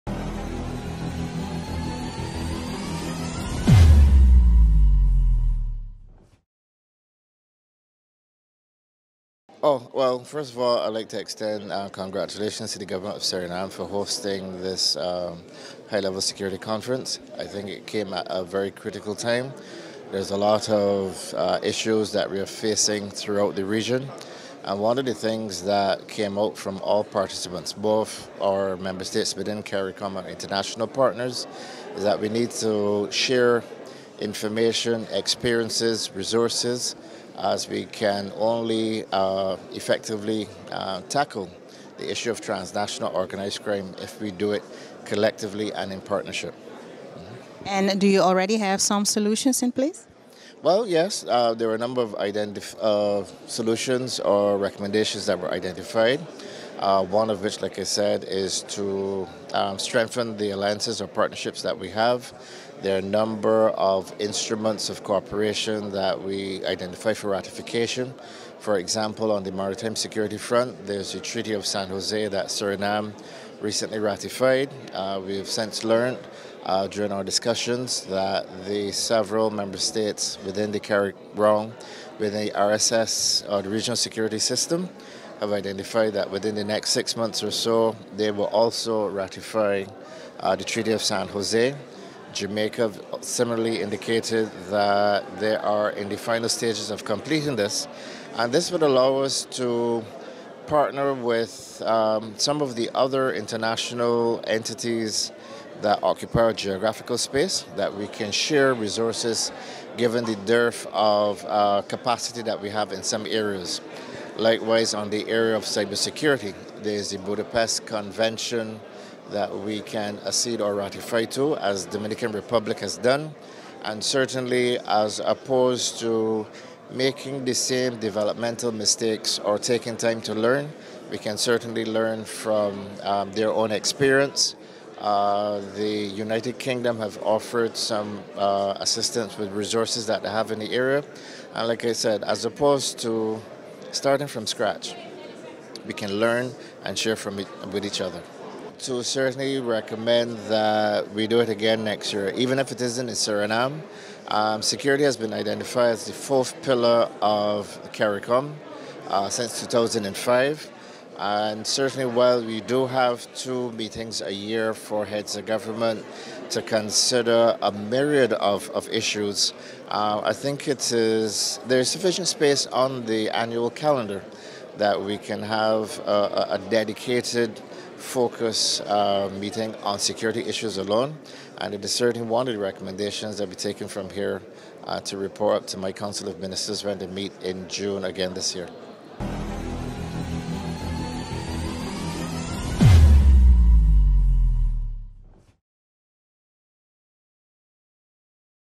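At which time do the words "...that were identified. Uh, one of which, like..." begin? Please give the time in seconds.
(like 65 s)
55 s.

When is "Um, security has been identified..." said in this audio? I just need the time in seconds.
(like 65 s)
154 s.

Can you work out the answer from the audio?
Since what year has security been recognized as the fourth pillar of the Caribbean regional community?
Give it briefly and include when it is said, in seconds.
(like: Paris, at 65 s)
2005, at 159 s.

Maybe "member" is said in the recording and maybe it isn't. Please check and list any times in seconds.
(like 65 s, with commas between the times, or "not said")
28 s, 79 s.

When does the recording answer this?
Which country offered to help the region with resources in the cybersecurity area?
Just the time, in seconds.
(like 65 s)
136 s.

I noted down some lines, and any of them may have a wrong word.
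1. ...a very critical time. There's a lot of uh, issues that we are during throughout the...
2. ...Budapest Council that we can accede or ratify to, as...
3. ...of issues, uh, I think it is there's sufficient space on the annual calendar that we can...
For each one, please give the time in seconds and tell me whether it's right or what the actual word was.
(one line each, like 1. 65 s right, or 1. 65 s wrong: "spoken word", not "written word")
1. 18 s wrong: "facing", not "during"
2. 117 s wrong: "Convention", not "Council"
3. 168 s right.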